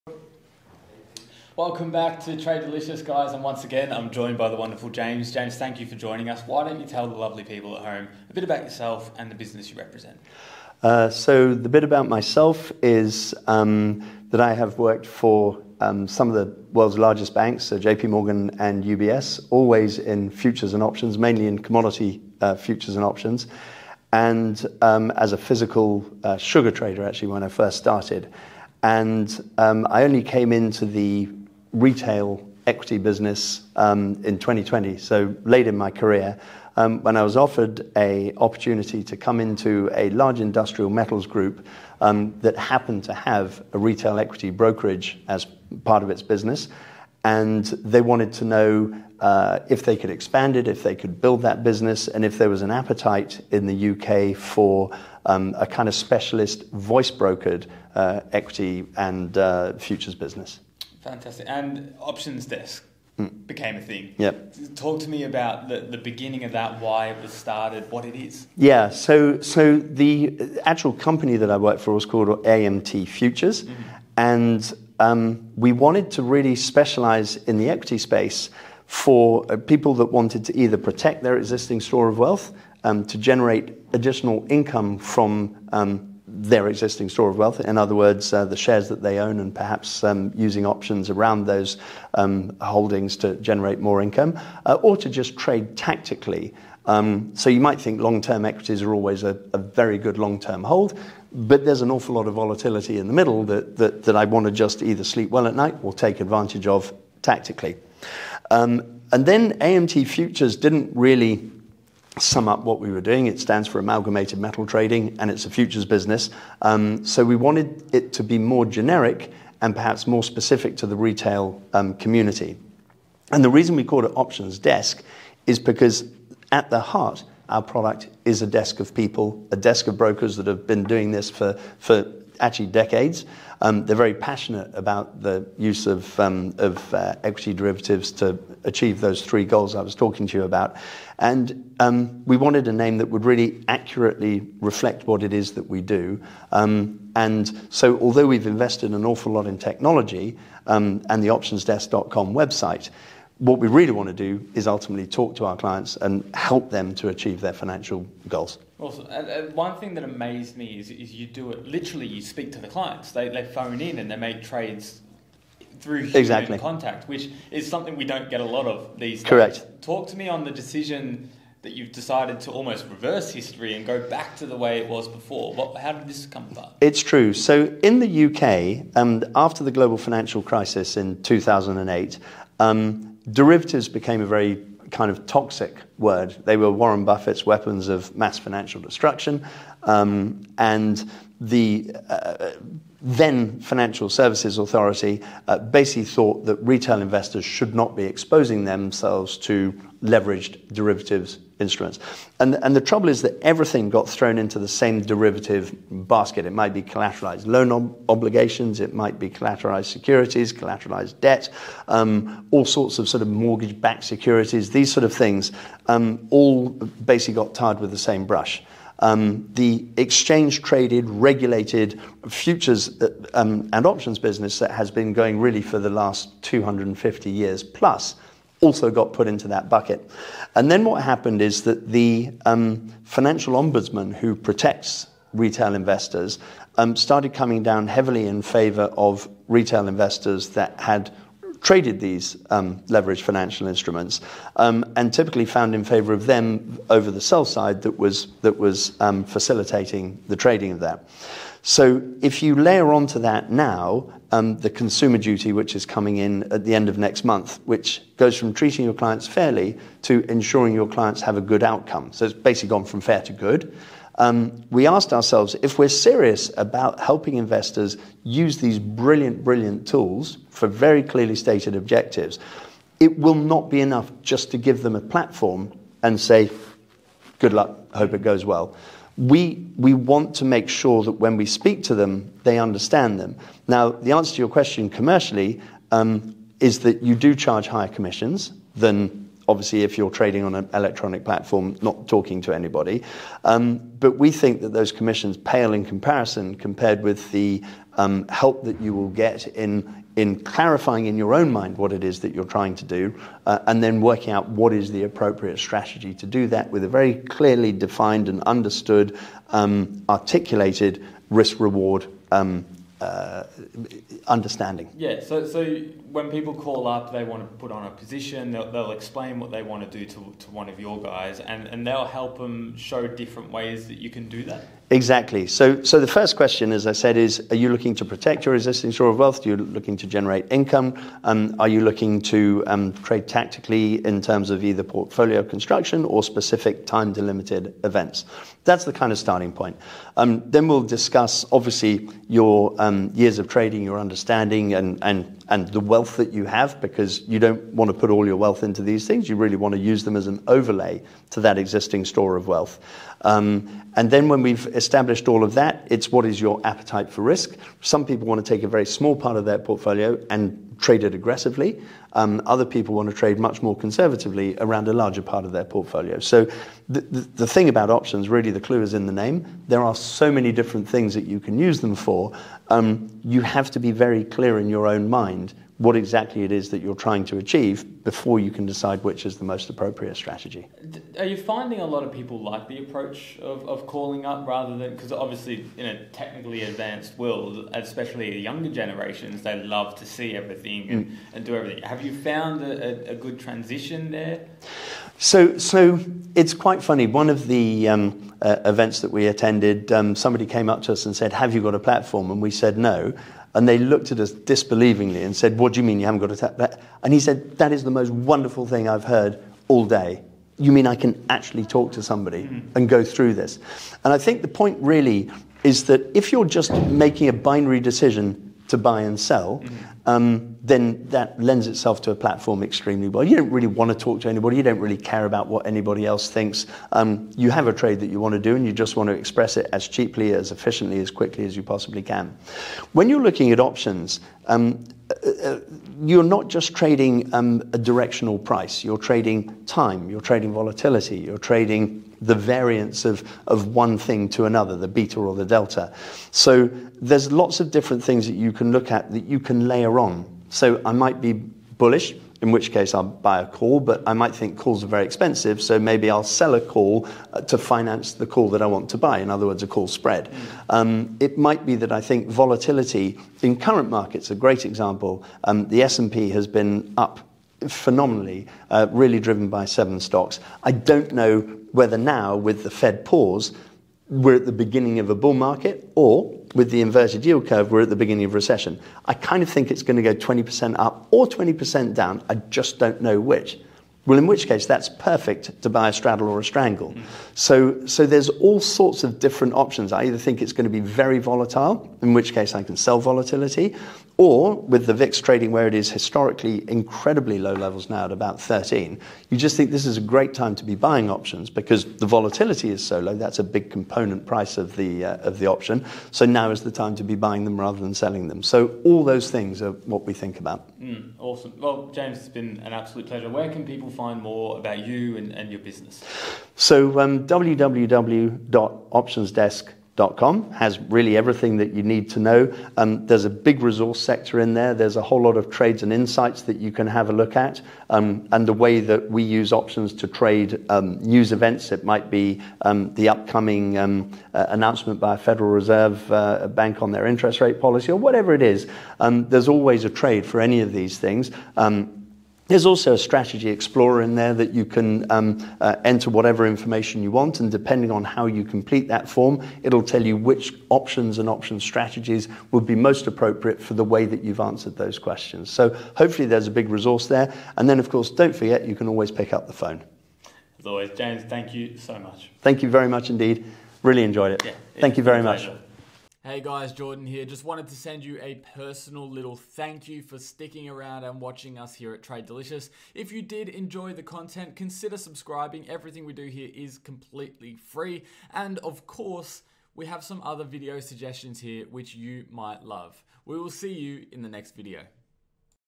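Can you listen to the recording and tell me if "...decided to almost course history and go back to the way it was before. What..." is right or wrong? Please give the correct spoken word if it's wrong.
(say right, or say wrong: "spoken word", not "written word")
wrong: "reverse", not "course".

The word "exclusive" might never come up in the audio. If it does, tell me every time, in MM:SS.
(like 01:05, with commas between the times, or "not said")
not said.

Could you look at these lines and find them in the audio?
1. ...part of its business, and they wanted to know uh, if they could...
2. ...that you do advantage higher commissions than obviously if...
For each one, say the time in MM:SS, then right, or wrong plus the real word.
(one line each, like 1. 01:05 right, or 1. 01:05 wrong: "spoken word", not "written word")
1. 00:45 right
2. 04:46 wrong: "charge", not "advantage".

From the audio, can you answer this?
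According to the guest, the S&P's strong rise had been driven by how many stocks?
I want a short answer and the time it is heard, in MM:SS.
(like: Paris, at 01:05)
7, at 07:49.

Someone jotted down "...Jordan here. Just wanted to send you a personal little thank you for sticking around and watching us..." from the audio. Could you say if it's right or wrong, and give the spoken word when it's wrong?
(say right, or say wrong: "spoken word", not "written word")
right.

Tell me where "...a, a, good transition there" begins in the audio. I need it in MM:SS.
06:33.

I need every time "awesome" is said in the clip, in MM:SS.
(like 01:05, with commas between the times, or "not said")
02:38, 08:31.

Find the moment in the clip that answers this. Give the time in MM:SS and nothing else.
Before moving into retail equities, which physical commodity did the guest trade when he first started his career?
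00:26.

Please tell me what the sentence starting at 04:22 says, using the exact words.
So it's basically gone from fair to good.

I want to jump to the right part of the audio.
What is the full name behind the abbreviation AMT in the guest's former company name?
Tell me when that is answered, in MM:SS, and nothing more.
01:53.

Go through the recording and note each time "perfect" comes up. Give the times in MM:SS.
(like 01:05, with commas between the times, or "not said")
08:04.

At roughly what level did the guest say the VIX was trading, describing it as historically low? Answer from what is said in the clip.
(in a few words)
13.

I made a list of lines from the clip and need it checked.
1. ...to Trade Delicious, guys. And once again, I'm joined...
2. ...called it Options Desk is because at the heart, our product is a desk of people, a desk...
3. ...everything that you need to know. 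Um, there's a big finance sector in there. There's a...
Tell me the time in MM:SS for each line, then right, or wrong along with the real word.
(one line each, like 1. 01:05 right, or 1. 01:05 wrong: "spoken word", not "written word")
1. 00:02 right
2. 02:03 right
3. 08:41 wrong: "resource", not "finance".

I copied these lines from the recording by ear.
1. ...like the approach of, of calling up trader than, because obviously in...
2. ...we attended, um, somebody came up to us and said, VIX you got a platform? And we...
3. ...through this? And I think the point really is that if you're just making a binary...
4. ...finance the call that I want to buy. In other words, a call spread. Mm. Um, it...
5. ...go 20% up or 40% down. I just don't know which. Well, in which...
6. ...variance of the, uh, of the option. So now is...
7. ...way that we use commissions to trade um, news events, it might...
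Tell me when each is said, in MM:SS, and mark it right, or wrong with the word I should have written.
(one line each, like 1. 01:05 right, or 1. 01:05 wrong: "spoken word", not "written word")
1. 06:22 wrong: "rather", not "trader"
2. 06:39 wrong: "Have", not "VIX"
3. 06:53 right
4. 07:37 right
5. 08:00 wrong: "20", not "40"
6. 08:24 wrong: "price", not "variance"
7. 08:48 wrong: "options", not "commissions".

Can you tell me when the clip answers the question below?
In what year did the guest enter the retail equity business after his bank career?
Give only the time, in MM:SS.
00:34.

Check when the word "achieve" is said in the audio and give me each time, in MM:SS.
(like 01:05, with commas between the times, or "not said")
02:18, 02:37, 06:17.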